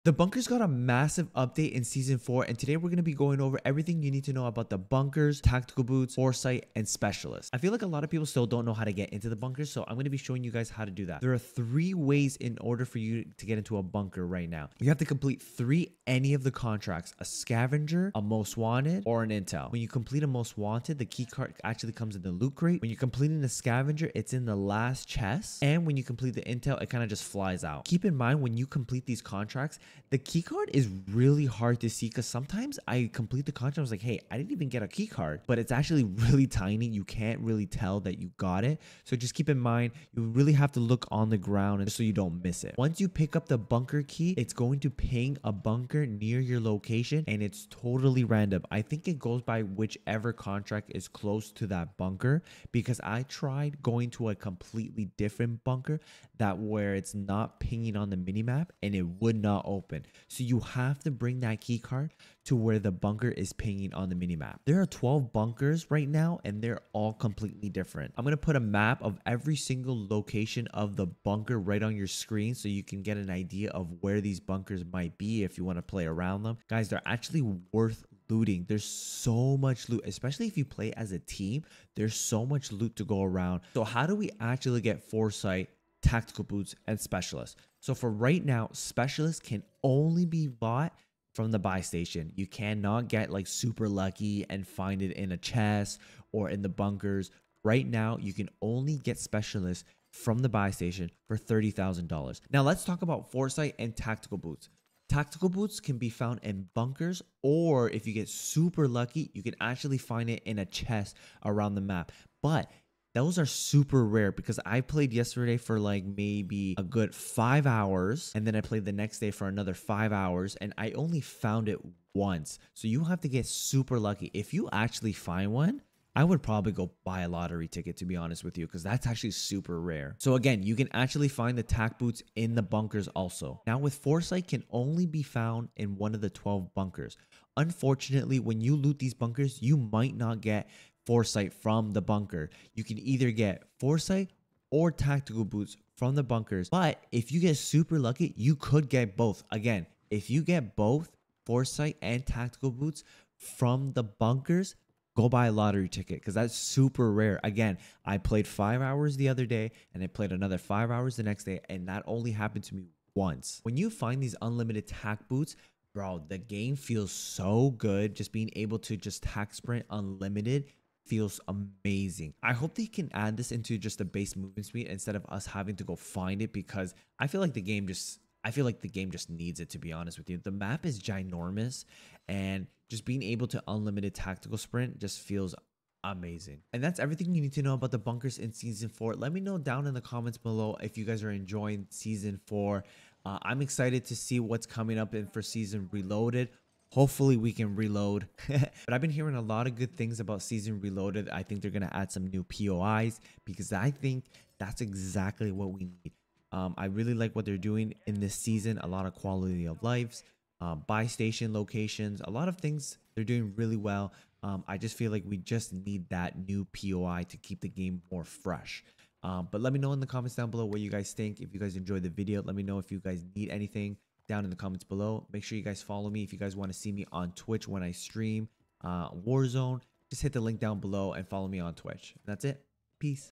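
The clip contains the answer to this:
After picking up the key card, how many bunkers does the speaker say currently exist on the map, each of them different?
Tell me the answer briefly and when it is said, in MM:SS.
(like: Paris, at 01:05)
12, at 01:04.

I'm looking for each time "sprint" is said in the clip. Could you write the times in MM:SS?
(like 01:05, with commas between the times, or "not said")
02:49, 03:04.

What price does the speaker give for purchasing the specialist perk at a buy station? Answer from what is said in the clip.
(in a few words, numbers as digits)
$30,000.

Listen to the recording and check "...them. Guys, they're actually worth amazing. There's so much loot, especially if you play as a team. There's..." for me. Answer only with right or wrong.
wrong.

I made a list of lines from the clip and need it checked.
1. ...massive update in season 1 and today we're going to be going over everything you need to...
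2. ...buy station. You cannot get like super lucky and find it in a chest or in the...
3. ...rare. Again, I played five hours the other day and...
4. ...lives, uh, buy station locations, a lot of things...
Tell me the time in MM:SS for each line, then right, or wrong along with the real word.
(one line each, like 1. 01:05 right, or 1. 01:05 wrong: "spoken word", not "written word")
1. 00:00 wrong: "4", not "1"
2. 01:31 right
3. 02:37 right
4. 03:29 right.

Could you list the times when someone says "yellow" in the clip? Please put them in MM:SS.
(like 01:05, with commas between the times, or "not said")
not said.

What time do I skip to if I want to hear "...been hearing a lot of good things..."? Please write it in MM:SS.
03:19.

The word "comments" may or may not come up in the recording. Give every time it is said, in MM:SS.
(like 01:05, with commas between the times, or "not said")
03:10, 03:40, 03:44.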